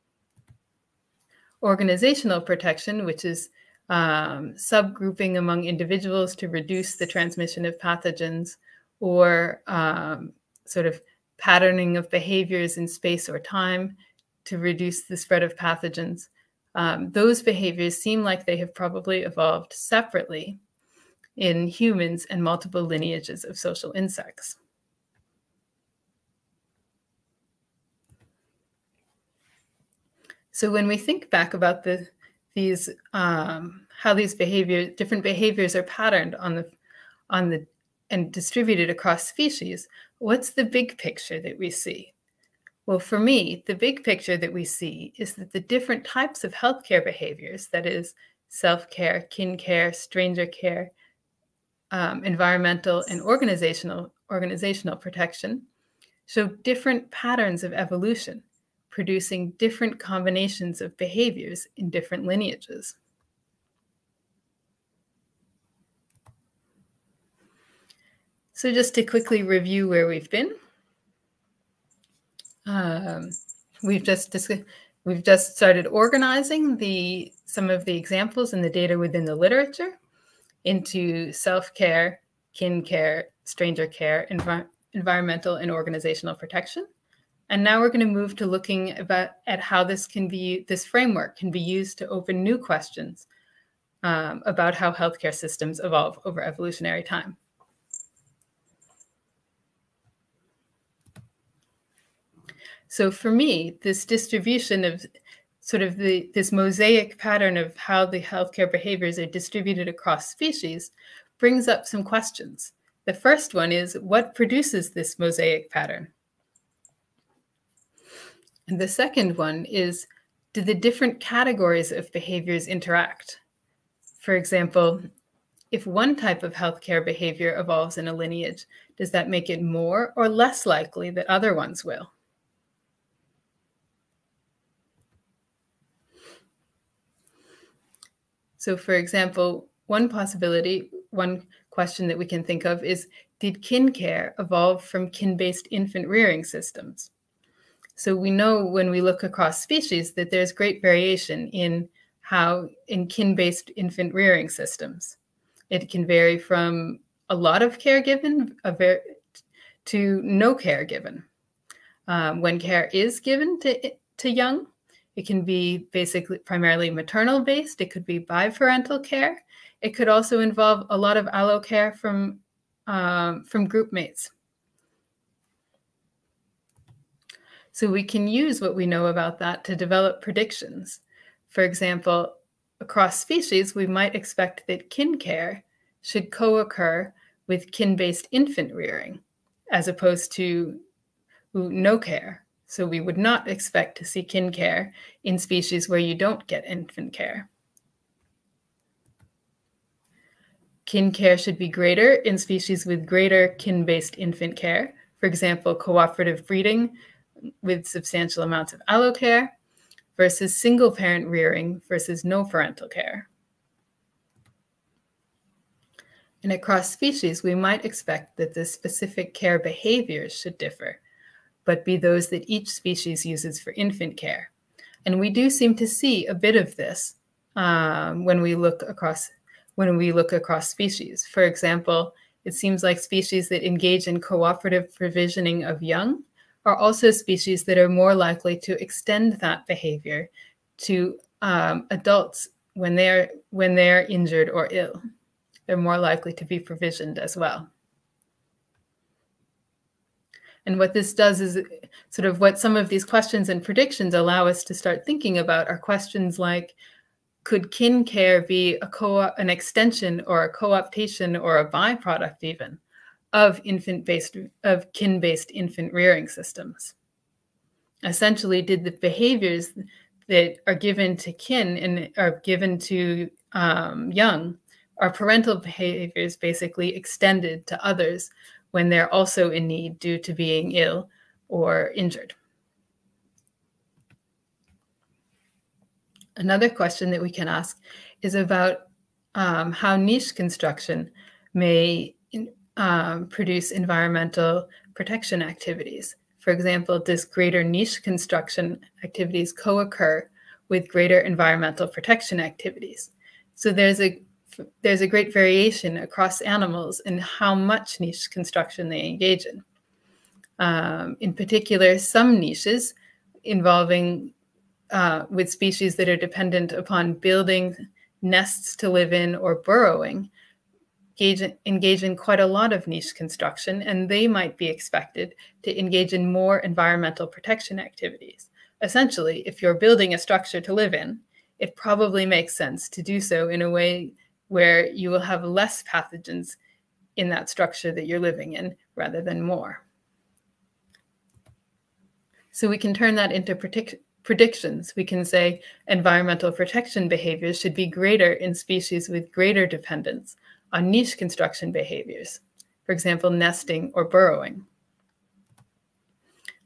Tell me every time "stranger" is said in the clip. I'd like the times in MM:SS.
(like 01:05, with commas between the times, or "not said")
00:49, 01:23.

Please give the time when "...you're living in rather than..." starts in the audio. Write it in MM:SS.
05:38.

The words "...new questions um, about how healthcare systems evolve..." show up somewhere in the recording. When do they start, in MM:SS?
01:32.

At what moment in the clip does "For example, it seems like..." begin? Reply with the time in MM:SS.
03:51.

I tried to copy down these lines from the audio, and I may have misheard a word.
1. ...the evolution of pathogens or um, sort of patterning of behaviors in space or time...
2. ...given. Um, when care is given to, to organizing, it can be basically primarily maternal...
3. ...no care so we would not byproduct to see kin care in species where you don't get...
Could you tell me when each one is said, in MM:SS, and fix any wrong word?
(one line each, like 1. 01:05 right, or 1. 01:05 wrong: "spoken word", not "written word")
1. 00:06 wrong: "transmission", not "evolution"
2. 02:40 wrong: "young", not "organizing"
3. 03:11 wrong: "expect", not "byproduct".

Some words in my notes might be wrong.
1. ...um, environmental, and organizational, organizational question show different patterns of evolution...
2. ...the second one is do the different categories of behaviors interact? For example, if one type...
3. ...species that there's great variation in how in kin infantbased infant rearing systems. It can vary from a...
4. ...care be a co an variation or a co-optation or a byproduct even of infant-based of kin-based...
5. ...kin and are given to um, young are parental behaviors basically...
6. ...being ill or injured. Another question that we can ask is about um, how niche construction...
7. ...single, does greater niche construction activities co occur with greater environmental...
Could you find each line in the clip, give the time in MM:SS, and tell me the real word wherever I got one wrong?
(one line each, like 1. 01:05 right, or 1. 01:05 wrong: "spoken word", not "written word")
1. 00:51 wrong: "protection", not "question"
2. 01:58 right
3. 02:29 wrong: "based", not "infantbased"
4. 04:18 wrong: "extension", not "variation"
5. 04:31 right
6. 04:40 right
7. 04:56 wrong: "example", not "single".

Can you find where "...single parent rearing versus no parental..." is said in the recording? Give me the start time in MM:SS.
03:30.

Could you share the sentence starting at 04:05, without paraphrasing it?
They're more likely to be provisioned as well.